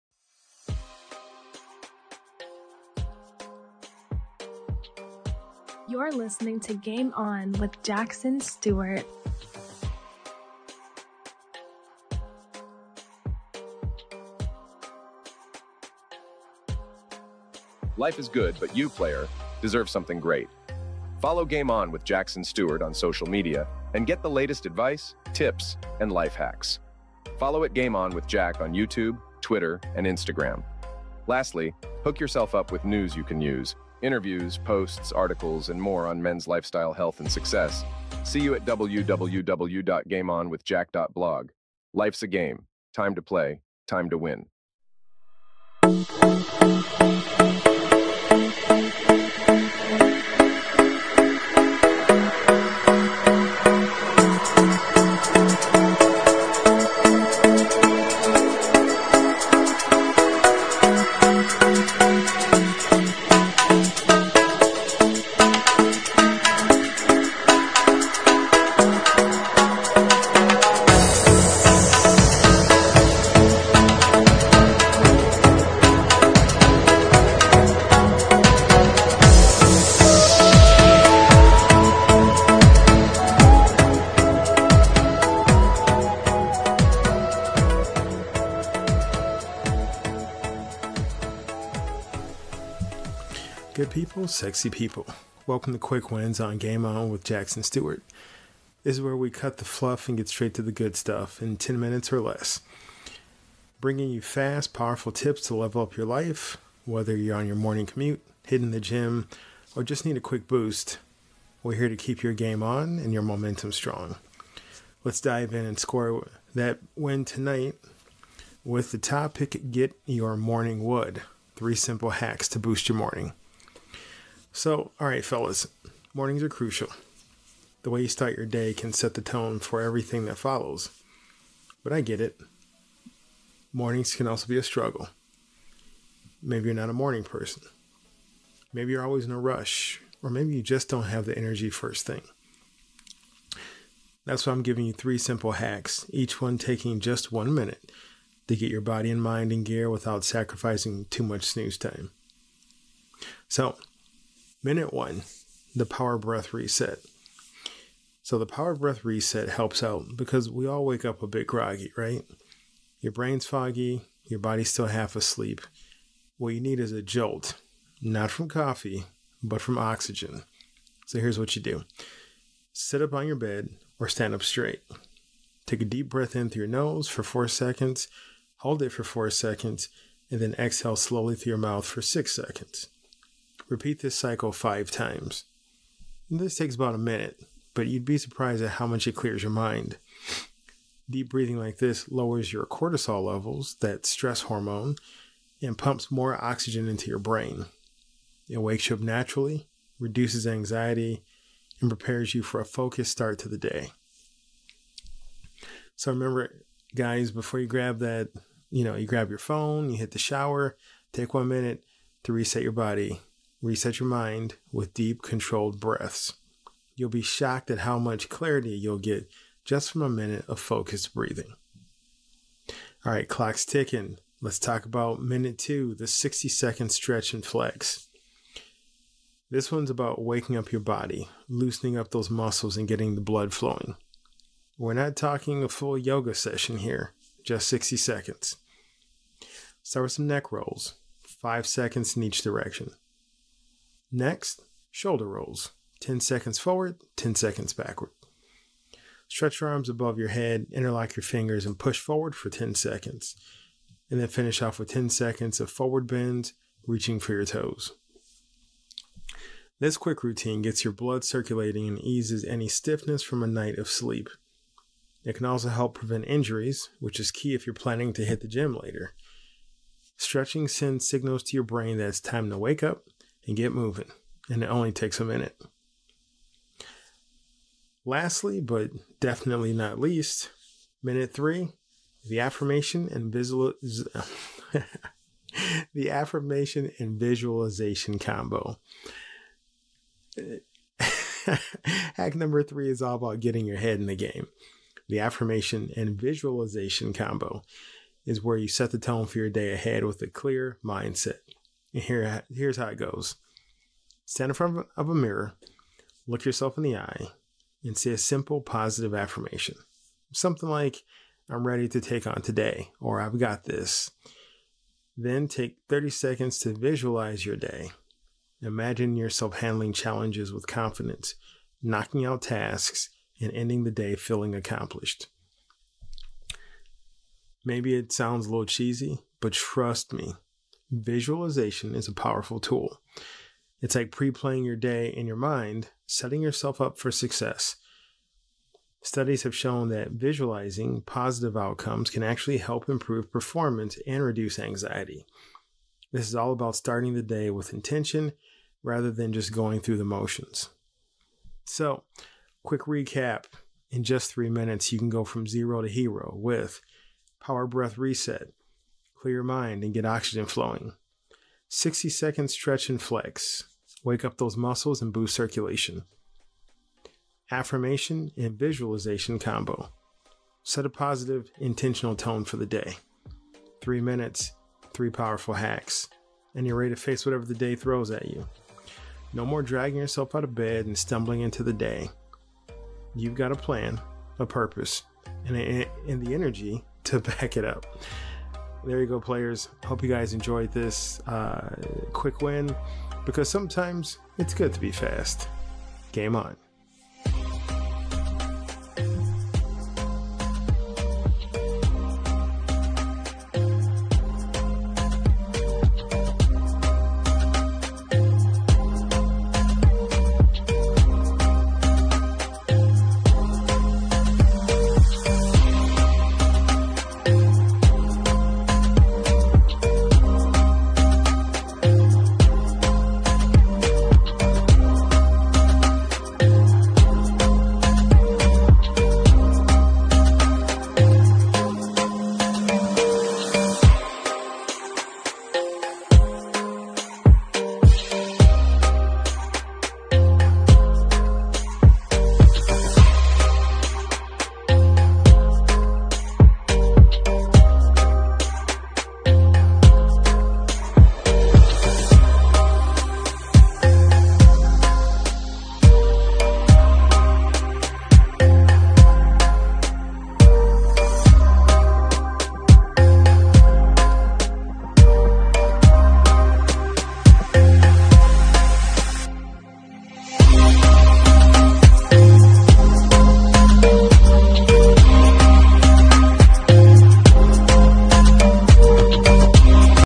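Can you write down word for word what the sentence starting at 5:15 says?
Then take 30 seconds to visualize your day.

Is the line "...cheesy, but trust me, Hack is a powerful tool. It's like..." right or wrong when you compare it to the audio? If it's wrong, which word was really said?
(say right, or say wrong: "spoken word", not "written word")
wrong: "Visualization", not "Hack".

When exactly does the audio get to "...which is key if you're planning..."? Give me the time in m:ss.
4:26.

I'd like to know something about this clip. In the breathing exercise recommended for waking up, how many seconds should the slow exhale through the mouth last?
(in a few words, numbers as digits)
6 seconds.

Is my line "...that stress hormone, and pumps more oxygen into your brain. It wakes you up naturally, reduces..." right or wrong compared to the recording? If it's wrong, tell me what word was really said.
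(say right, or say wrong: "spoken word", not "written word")
right.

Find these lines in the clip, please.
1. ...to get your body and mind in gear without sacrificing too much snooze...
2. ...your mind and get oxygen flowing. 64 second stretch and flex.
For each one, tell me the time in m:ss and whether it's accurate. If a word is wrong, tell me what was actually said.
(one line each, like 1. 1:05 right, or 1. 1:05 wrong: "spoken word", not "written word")
1. 2:28 right
2. 5:59 wrong: "60", not "64".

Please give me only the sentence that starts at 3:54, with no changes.
We're not talking a full yoga session here, just 60 seconds.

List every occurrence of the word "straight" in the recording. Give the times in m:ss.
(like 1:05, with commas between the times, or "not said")
1:40, 2:54.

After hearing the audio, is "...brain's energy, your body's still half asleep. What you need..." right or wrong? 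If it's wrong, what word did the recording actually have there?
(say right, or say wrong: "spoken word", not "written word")
wrong: "foggy", not "energy".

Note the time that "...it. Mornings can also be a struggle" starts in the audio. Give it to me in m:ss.
2:12.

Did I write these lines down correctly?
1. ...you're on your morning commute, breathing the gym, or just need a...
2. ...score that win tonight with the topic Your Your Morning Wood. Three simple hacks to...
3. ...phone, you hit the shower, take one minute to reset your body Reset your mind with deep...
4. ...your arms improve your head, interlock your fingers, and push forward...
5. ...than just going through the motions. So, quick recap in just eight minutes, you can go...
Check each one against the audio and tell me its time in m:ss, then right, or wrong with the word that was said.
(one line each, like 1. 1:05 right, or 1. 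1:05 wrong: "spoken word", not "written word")
1. 1:47 wrong: "hitting", not "breathing"
2. 1:55 wrong: "Get", not "Your"
3. 3:29 right
4. 4:09 wrong: "above", not "improve"
5. 5:49 wrong: "three", not "eight".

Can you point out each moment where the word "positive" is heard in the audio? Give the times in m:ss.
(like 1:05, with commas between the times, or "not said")
5:08, 5:41, 6:10.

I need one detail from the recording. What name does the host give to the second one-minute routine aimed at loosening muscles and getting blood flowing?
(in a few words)
60 second stretch and flex.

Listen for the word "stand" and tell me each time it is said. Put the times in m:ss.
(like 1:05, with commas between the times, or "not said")
2:54, 5:04.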